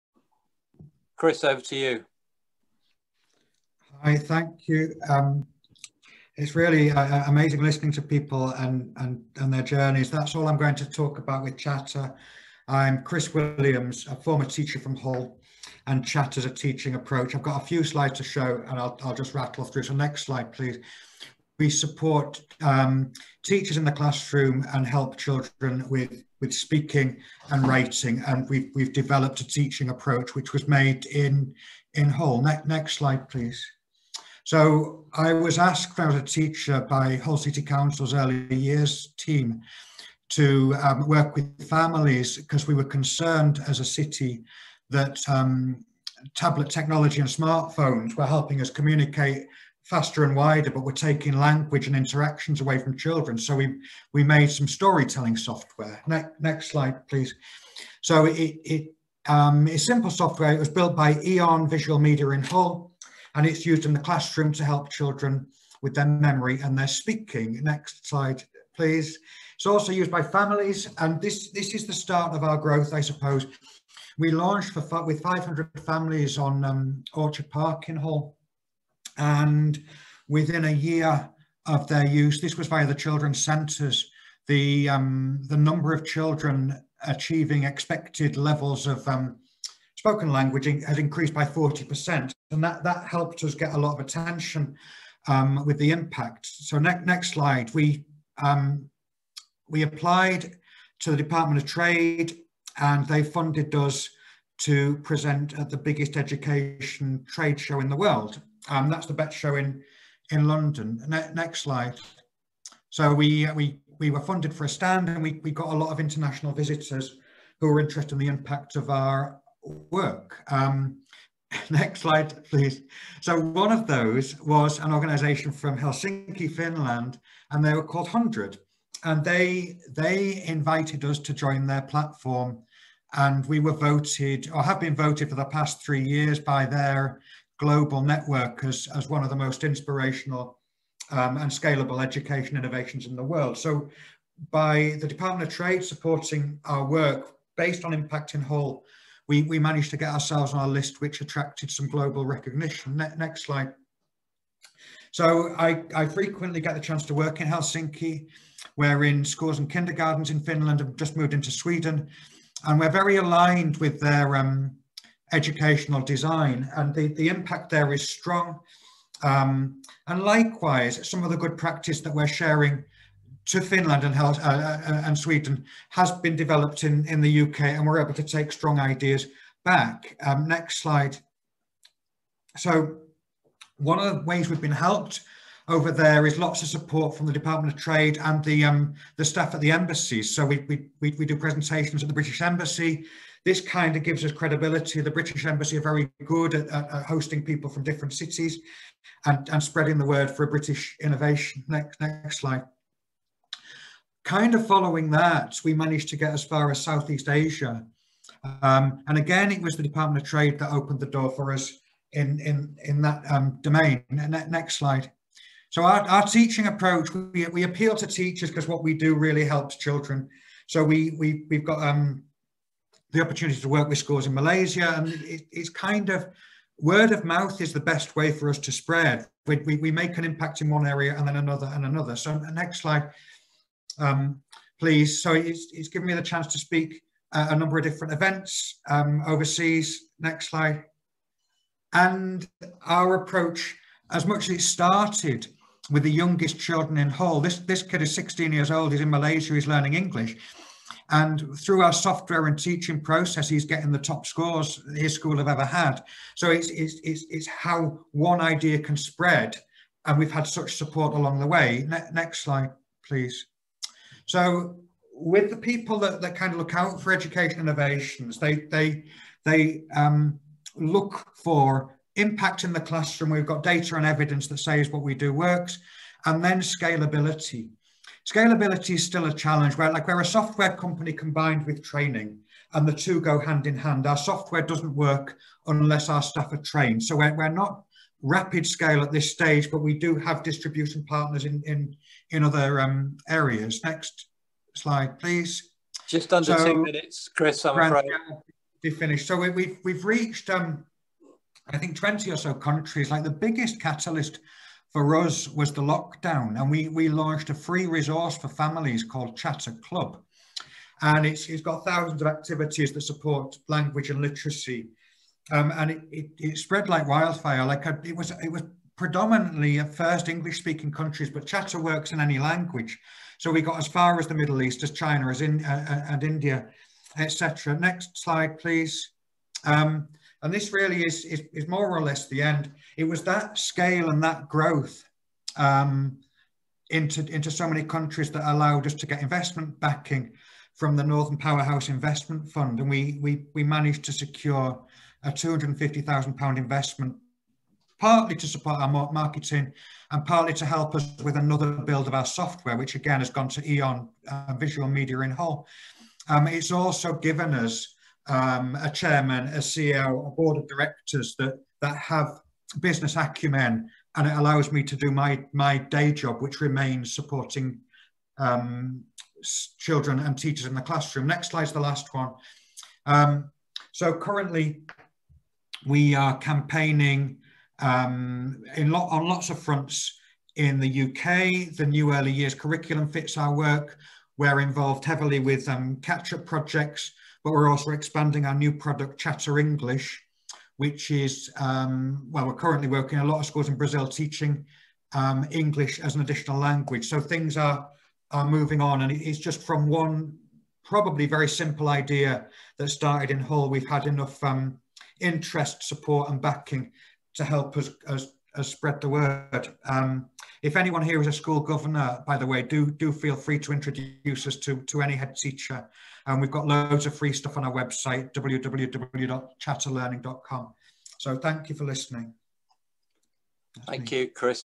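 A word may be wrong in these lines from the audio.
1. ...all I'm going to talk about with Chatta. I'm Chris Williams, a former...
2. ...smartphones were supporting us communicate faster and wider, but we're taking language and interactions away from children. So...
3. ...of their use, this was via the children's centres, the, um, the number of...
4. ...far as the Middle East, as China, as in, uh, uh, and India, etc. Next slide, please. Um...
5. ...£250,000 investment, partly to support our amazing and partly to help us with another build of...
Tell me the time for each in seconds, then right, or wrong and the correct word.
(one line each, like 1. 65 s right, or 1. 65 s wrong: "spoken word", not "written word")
1. 10 s right
2. 47 s wrong: "helping", not "supporting"
3. 81 s right
4. 323 s right
5. 345 s wrong: "marketing", not "amazing".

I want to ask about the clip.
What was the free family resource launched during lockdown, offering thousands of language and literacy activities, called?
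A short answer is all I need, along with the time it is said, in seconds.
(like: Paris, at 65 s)
Chatta Club, at 309 s.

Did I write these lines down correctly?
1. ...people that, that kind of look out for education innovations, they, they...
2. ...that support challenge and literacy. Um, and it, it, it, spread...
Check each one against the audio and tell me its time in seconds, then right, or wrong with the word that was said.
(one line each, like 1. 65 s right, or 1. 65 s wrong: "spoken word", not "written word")
1. 265 s right
2. 312 s wrong: "language", not "challenge".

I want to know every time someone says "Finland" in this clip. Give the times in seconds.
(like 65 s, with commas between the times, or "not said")
126 s, 160 s, 173 s.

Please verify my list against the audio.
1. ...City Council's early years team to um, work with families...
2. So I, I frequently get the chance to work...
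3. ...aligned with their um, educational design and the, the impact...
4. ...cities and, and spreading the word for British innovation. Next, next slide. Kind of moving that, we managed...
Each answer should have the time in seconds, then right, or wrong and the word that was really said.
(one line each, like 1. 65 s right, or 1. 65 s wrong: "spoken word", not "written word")
1. 37 s right
2. 155 s right
3. 163 s right
4. 198 s wrong: "following", not "moving".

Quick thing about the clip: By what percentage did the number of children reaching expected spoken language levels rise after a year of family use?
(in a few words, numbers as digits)
40%.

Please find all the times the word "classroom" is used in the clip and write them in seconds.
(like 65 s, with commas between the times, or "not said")
23 s, 63 s, 272 s, 370 s.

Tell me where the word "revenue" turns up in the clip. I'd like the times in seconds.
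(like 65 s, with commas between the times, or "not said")
not said.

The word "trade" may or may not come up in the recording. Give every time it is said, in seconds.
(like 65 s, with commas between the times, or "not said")
101 s, 107 s, 145 s, 187 s, 210 s.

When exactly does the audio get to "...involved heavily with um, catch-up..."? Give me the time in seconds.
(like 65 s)
384 s.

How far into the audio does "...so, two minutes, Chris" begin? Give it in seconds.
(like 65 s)
296 s.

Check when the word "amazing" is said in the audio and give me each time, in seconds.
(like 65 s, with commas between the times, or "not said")
7 s.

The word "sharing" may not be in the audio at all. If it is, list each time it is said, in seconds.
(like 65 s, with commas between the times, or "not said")
172 s.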